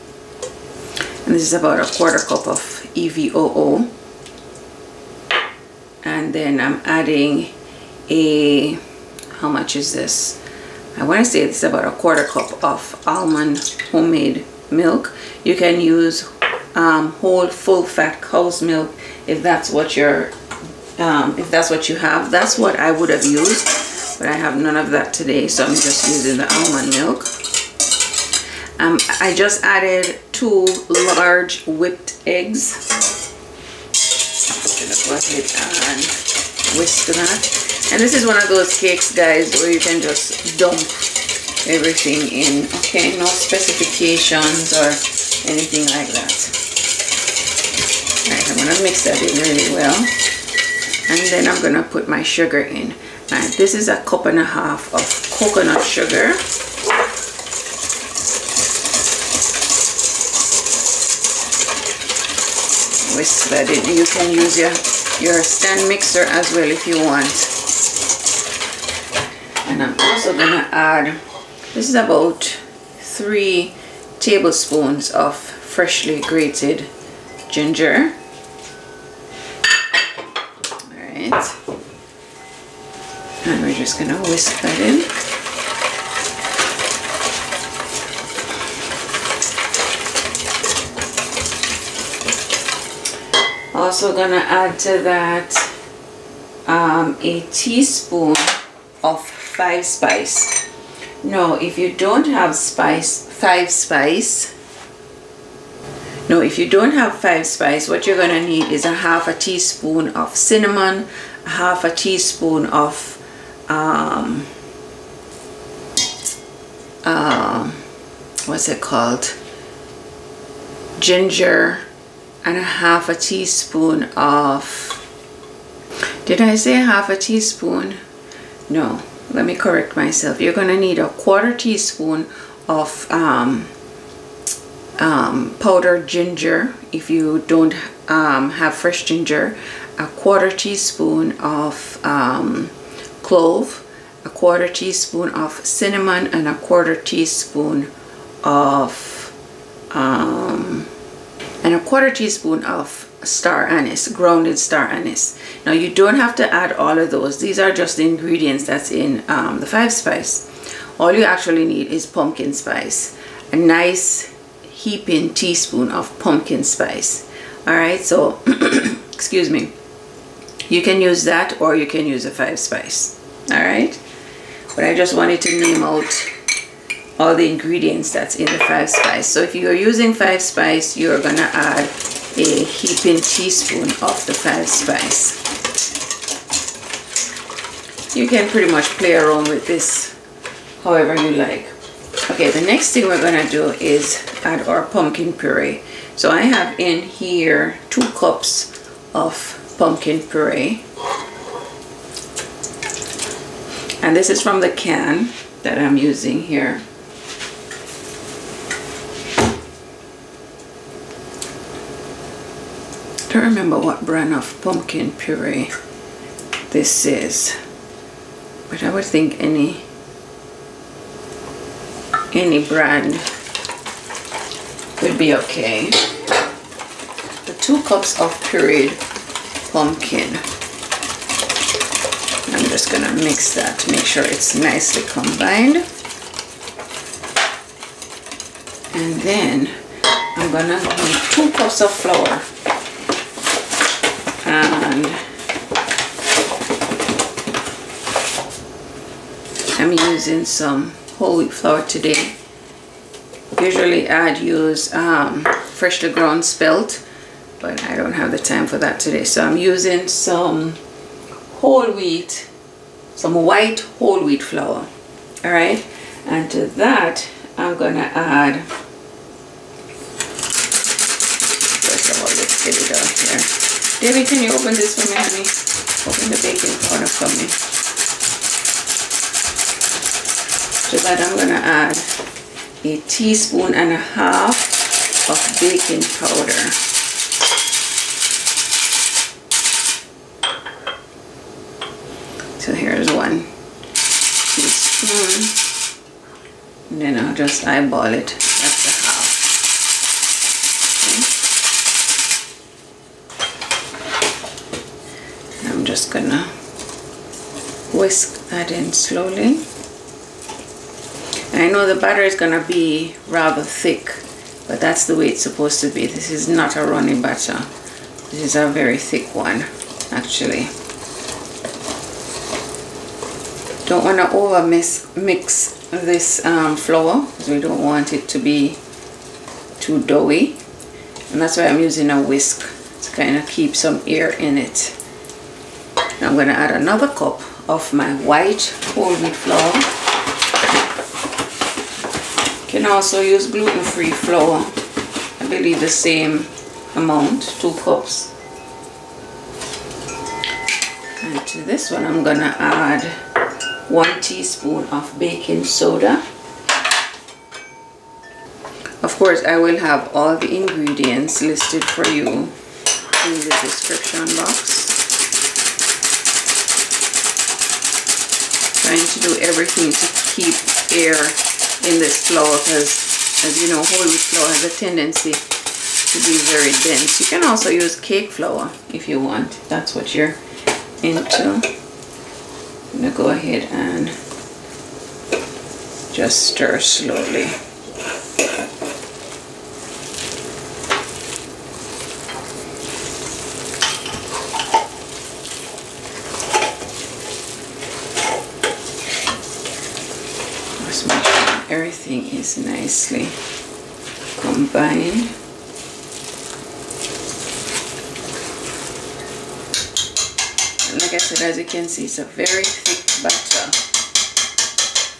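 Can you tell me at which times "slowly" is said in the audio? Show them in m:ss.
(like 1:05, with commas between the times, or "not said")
5:08, 6:26.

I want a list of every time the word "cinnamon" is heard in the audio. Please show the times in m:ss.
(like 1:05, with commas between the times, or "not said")
1:50, 2:25.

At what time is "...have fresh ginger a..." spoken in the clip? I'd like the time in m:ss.
2:18.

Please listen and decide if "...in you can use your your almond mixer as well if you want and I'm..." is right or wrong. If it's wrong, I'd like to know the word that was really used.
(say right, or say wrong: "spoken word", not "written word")
wrong: "stand", not "almond".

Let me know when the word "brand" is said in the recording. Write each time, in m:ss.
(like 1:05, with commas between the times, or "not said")
3:34, 3:42.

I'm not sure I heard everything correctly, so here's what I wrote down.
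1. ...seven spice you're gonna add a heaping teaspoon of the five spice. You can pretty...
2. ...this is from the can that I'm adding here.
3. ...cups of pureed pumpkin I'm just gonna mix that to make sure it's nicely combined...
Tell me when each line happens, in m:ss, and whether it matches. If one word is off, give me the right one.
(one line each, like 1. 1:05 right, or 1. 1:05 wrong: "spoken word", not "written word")
1. 3:00 wrong: "five", not "seven"
2. 3:24 wrong: "using", not "adding"
3. 3:47 right.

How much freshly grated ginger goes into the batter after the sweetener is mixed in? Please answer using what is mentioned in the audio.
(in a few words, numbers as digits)
3 tablespoons.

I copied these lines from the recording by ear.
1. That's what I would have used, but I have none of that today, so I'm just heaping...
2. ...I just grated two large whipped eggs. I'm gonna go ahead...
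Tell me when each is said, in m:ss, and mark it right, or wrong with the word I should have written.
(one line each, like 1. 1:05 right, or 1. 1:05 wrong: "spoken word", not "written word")
1. 0:22 wrong: "using", not "heaping"
2. 0:29 wrong: "added", not "grated".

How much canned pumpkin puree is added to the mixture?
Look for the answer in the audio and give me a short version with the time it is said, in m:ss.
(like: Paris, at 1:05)
2 cups, at 3:17.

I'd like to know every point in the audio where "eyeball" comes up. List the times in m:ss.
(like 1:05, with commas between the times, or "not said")
4:57.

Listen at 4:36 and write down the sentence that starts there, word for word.
Open the baking powder for me.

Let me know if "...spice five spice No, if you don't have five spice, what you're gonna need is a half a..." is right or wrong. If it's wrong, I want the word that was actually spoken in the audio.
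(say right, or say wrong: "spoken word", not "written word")
right.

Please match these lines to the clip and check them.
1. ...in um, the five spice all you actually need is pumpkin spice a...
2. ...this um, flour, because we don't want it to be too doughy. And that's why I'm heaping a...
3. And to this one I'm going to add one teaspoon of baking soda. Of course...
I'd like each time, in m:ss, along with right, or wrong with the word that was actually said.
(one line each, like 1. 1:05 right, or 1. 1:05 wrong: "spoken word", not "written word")
1. 2:38 right
2. 5:25 wrong: "using", not "heaping"
3. 5:51 right.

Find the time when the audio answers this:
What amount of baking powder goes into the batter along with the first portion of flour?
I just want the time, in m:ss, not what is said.
4:42.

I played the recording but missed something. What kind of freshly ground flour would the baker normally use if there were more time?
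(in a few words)
spelt.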